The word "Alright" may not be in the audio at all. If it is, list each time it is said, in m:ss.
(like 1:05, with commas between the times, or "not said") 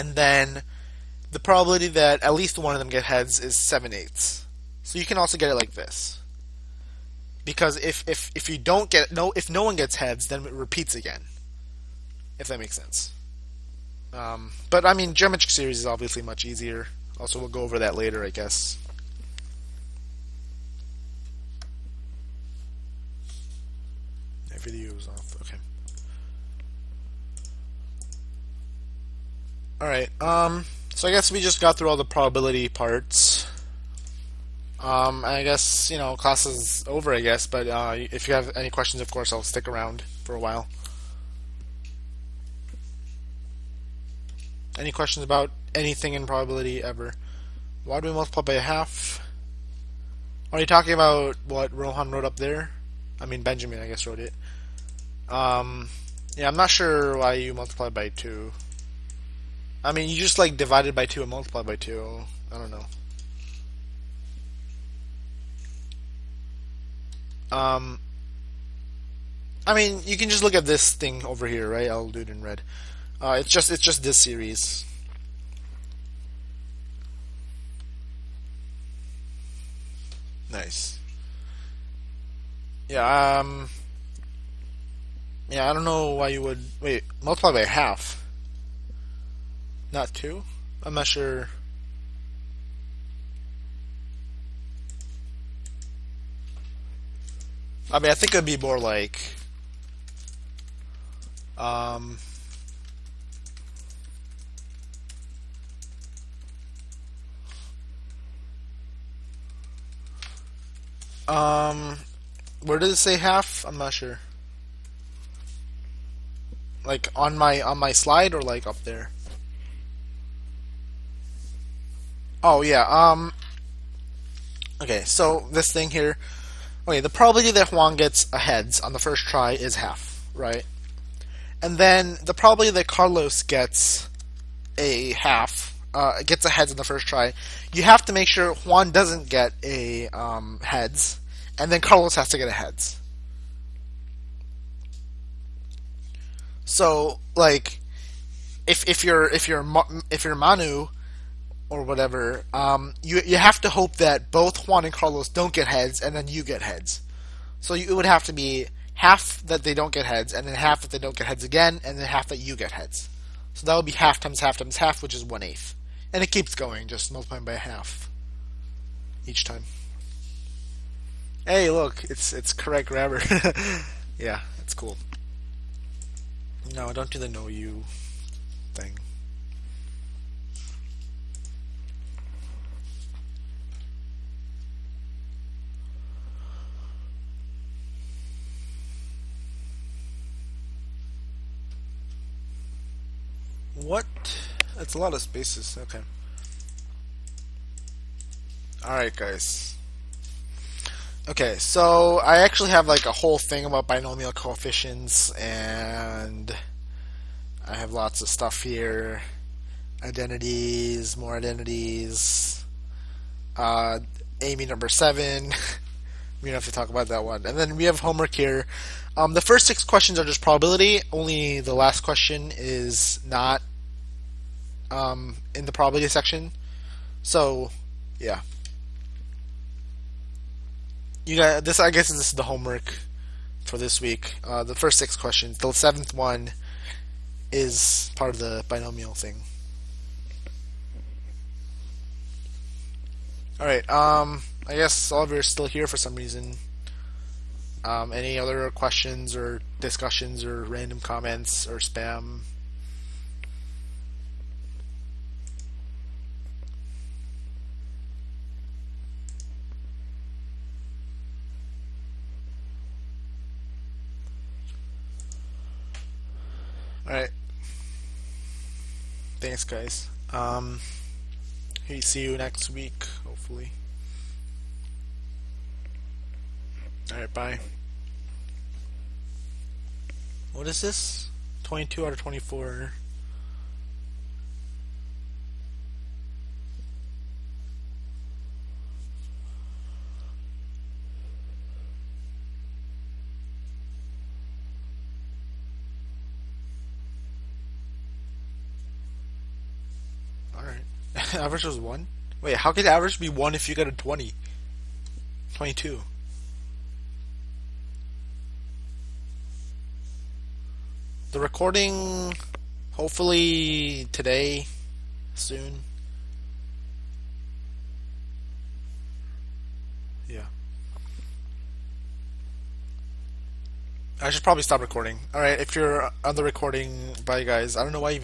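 3:18, 5:25.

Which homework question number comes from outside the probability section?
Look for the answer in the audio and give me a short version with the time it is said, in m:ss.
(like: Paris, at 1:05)
7, at 3:55.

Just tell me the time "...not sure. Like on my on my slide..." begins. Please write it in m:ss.
1:53.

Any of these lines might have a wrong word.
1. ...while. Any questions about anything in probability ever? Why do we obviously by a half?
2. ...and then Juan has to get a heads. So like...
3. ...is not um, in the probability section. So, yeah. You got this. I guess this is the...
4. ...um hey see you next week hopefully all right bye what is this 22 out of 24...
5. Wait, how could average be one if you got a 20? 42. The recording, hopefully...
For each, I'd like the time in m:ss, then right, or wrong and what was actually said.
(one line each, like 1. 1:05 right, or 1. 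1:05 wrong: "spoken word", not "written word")
1. 0:40 wrong: "multiply", not "obviously"
2. 2:21 wrong: "Carlos", not "Juan"
3. 3:42 right
4. 4:30 right
5. 5:02 wrong: "22", not "42".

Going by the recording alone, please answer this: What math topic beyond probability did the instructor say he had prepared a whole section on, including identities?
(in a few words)
binomial coefficients.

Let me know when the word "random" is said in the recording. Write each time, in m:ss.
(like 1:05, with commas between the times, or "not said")
4:10.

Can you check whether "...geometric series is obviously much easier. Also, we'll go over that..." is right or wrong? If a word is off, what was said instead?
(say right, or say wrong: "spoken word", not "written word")
right.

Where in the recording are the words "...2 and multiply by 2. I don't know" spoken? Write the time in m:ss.
1:01.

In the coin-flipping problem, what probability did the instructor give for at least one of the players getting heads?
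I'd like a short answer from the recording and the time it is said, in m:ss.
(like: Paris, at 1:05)
7/8, at 0:03.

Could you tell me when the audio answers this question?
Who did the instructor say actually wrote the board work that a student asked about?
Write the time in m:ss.
0:53.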